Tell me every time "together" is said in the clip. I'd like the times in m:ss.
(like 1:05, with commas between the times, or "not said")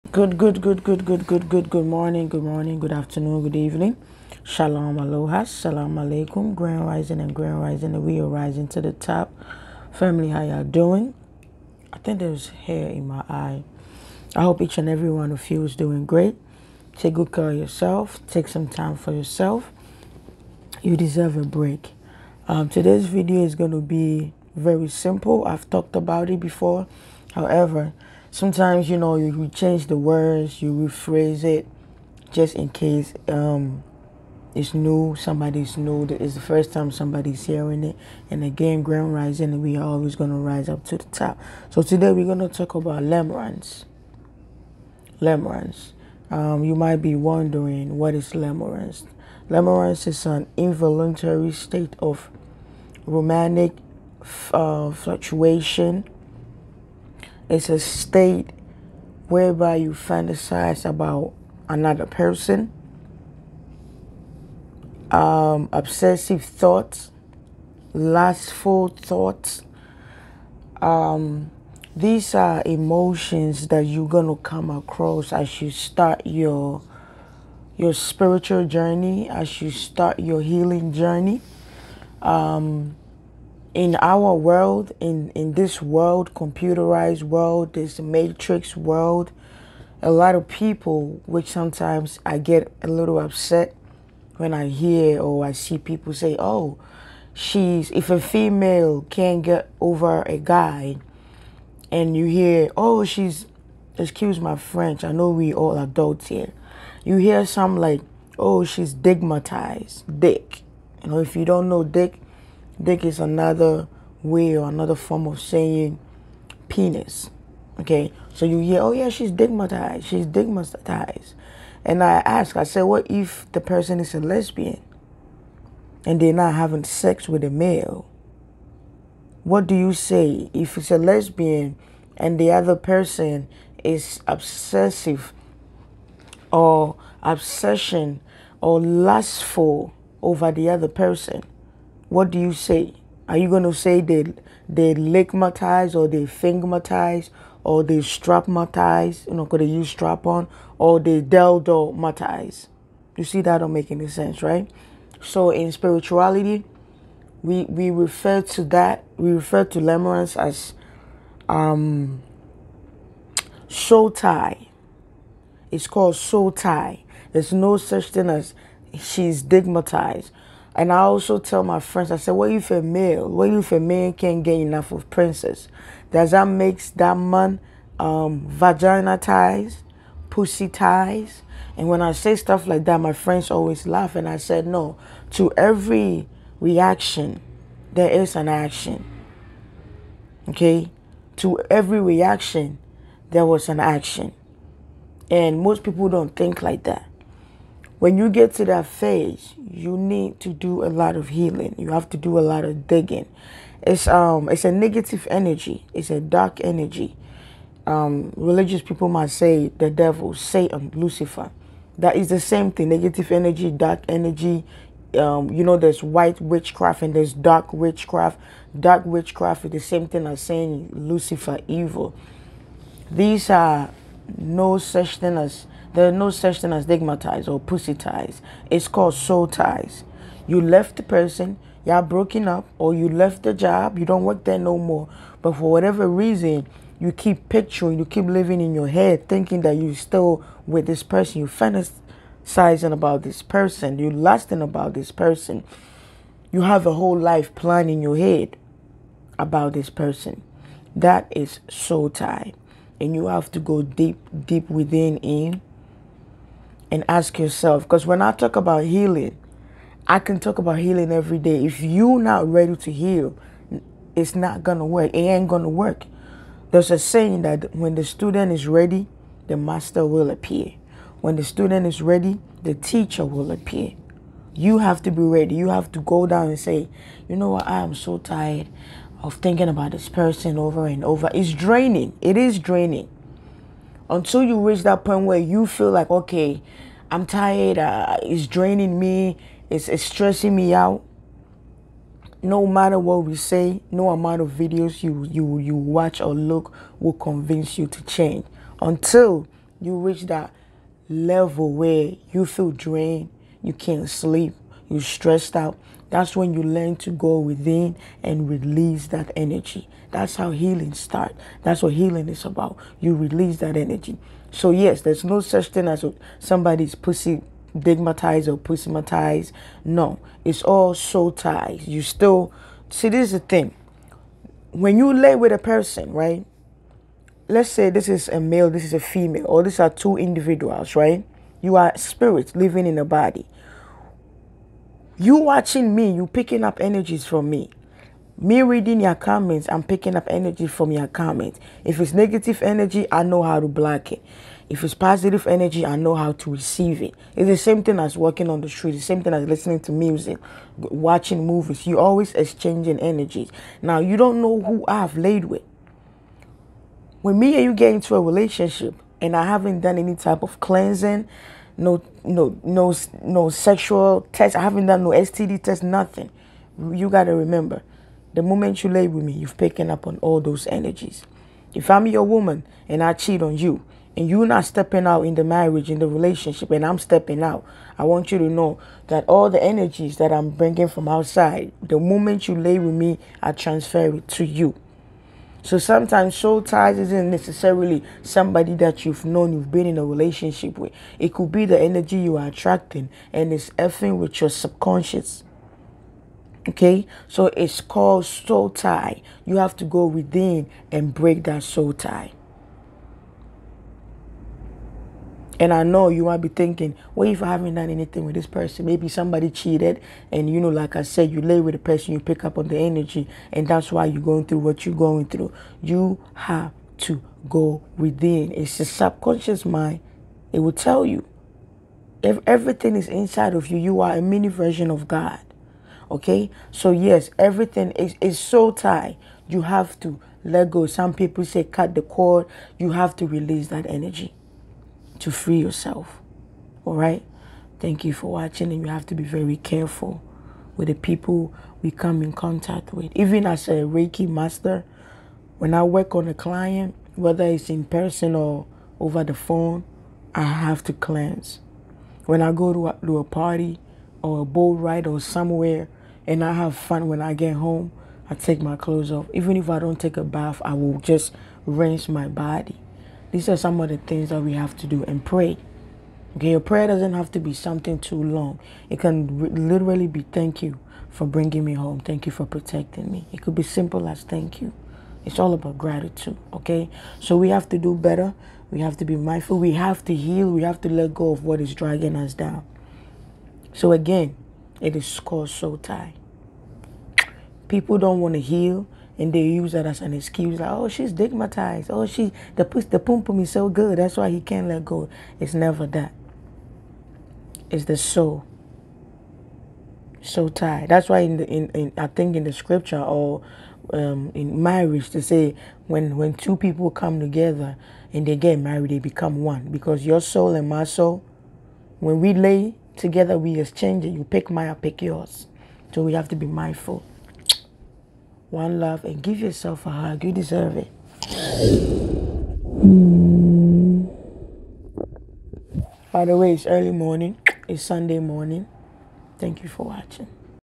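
8:27, 8:32.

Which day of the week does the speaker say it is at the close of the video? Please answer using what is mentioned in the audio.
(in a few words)
Sunday.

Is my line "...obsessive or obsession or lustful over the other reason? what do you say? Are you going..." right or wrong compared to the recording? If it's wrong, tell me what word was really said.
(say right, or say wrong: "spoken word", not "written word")
wrong: "person", not "reason".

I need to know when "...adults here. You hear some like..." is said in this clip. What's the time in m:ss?
1:45.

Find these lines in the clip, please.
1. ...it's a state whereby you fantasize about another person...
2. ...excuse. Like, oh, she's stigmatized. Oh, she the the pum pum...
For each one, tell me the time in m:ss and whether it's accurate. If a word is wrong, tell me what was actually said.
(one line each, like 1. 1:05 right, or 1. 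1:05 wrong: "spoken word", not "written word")
1. 0:57 right
2. 8:10 right.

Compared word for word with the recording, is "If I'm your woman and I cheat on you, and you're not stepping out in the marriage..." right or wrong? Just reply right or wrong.
right.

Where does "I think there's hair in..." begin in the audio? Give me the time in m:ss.
0:11.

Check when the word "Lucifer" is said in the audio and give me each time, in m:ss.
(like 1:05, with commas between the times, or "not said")
3:30, 3:40.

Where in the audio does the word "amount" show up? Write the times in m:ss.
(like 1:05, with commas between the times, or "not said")
4:54.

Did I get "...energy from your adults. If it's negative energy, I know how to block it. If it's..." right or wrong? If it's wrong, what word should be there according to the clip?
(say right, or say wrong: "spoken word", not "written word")
wrong: "comments", not "adults".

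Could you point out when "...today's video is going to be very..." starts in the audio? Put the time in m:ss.
0:22.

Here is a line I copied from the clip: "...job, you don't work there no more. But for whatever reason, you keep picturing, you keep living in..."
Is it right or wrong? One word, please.
right.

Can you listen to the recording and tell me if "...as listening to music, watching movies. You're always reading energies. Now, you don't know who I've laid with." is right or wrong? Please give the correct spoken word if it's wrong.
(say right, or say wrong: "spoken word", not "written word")
wrong: "exchanging", not "reading".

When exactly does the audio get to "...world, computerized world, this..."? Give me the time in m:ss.
1:25.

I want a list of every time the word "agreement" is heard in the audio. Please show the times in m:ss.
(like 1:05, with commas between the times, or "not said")
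not said.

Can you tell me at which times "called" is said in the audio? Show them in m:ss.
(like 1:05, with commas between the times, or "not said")
2:45, 3:48, 6:37, 8:05.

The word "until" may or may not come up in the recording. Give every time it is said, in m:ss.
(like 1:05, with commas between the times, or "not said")
4:44, 4:58.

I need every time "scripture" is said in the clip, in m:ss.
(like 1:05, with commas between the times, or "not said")
8:22.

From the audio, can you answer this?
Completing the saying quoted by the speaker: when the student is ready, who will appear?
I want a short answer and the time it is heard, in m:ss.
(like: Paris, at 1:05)
the master, at 4:29.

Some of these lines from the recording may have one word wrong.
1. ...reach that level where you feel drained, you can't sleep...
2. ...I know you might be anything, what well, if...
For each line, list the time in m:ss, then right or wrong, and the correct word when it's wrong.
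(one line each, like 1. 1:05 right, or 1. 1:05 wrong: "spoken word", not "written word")
1. 4:59 right
2. 6:45 wrong: "thinking", not "anything".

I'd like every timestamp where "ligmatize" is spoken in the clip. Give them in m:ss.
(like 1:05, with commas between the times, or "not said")
2:24.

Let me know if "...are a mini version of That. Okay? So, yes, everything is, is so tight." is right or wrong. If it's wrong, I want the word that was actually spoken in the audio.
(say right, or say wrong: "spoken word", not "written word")
wrong: "God", not "That".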